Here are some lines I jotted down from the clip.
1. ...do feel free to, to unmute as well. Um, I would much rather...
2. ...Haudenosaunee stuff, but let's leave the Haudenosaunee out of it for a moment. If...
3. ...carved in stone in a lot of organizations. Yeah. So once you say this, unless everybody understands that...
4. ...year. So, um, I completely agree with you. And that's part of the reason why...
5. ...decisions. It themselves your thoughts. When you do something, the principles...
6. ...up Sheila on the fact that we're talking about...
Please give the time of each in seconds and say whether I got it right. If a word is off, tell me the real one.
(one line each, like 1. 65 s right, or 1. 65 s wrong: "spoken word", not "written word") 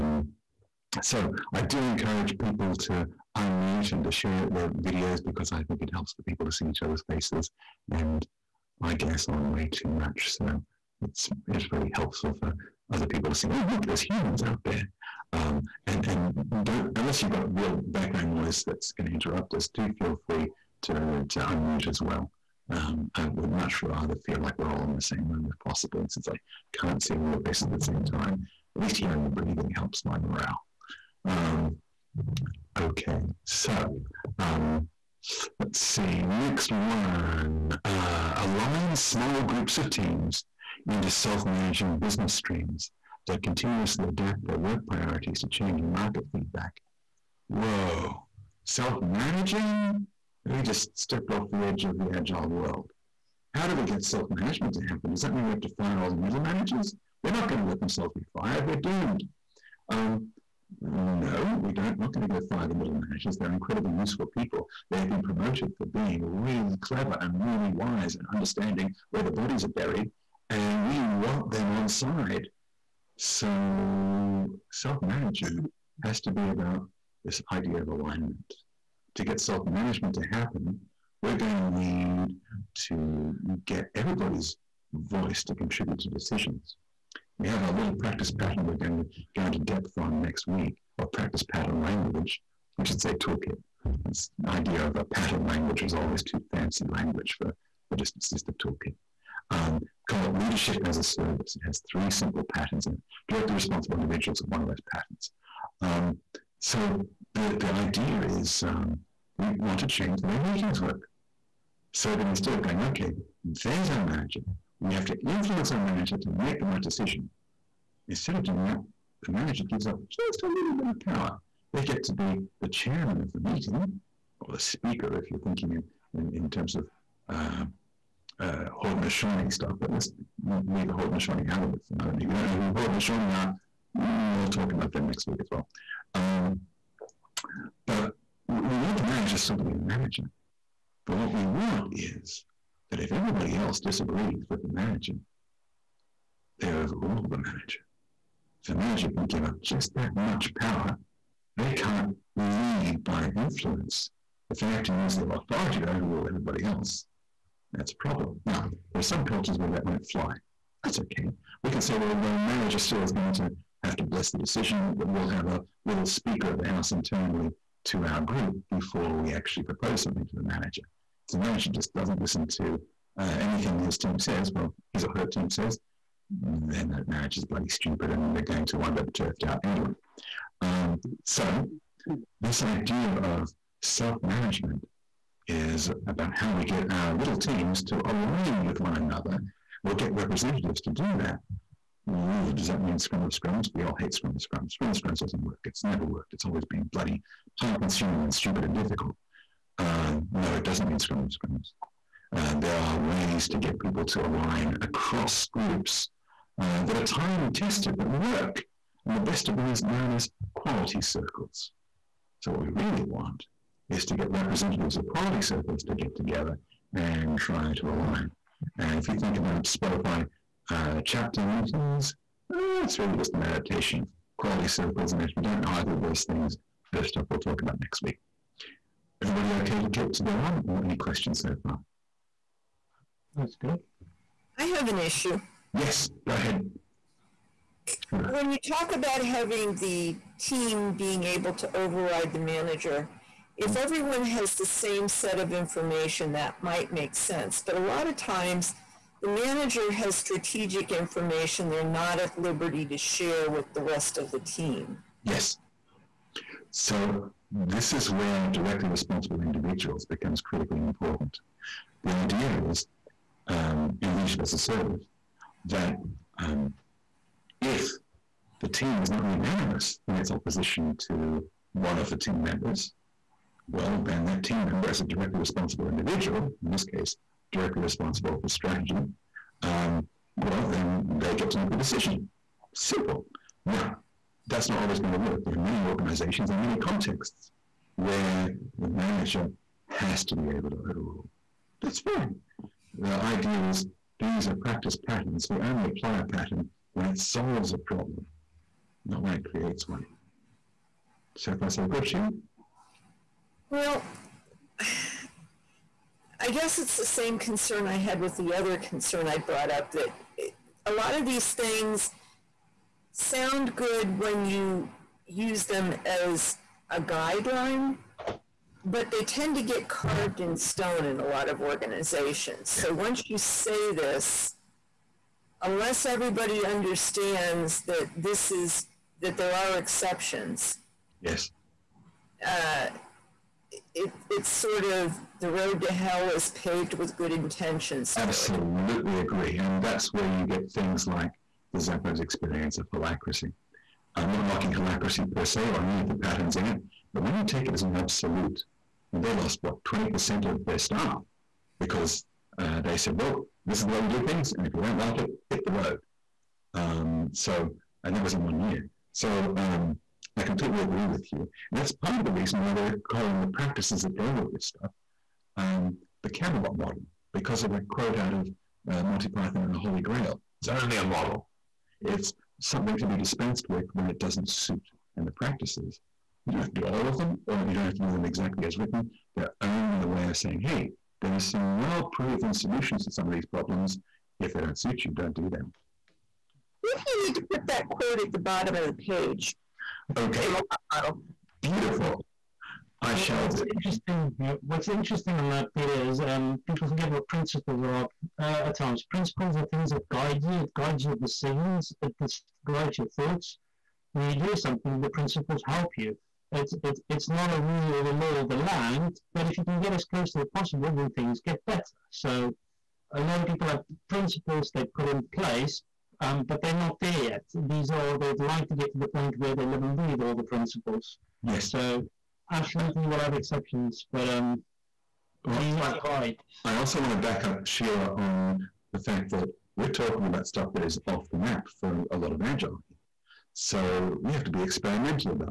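1. 19 s right
2. 128 s right
3. 319 s right
4. 358 s right
5. 401 s wrong: "guides", not "themselves"
6. 427 s right.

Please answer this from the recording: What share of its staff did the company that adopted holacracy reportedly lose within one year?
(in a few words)
20%.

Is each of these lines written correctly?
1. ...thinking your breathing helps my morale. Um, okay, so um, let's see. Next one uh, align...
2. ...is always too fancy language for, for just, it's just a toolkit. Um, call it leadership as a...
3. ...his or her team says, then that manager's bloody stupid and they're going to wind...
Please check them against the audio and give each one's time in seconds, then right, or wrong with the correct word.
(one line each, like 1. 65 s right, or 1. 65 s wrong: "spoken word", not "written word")
1. 28 s wrong: "hearing", not "thinking"
2. 95 s right
3. 174 s right.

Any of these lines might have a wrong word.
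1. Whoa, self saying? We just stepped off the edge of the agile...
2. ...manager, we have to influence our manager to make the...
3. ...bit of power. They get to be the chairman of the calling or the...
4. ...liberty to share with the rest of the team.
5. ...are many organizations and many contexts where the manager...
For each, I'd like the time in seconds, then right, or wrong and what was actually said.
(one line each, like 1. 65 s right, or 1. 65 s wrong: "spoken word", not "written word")
1. 47 s wrong: "managing", not "saying"
2. 113 s right
3. 120 s wrong: "meeting", not "calling"
4. 252 s right
5. 285 s right.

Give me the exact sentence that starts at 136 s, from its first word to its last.
Um, but we want the manager still to be the manager.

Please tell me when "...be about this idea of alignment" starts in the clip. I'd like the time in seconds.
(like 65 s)
76 s.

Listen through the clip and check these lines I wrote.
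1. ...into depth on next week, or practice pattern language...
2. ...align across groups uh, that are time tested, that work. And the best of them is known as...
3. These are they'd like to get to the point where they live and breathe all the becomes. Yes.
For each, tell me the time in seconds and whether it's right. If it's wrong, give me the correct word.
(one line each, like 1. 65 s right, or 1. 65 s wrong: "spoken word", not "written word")
1. 89 s right
2. 204 s right
3. 417 s wrong: "principles", not "becomes".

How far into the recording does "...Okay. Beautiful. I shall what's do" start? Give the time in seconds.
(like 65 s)
390 s.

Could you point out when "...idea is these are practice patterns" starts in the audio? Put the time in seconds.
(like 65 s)
293 s.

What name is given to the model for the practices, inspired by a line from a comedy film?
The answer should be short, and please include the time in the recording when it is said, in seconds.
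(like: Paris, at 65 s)
the Camelot model, at 366 s.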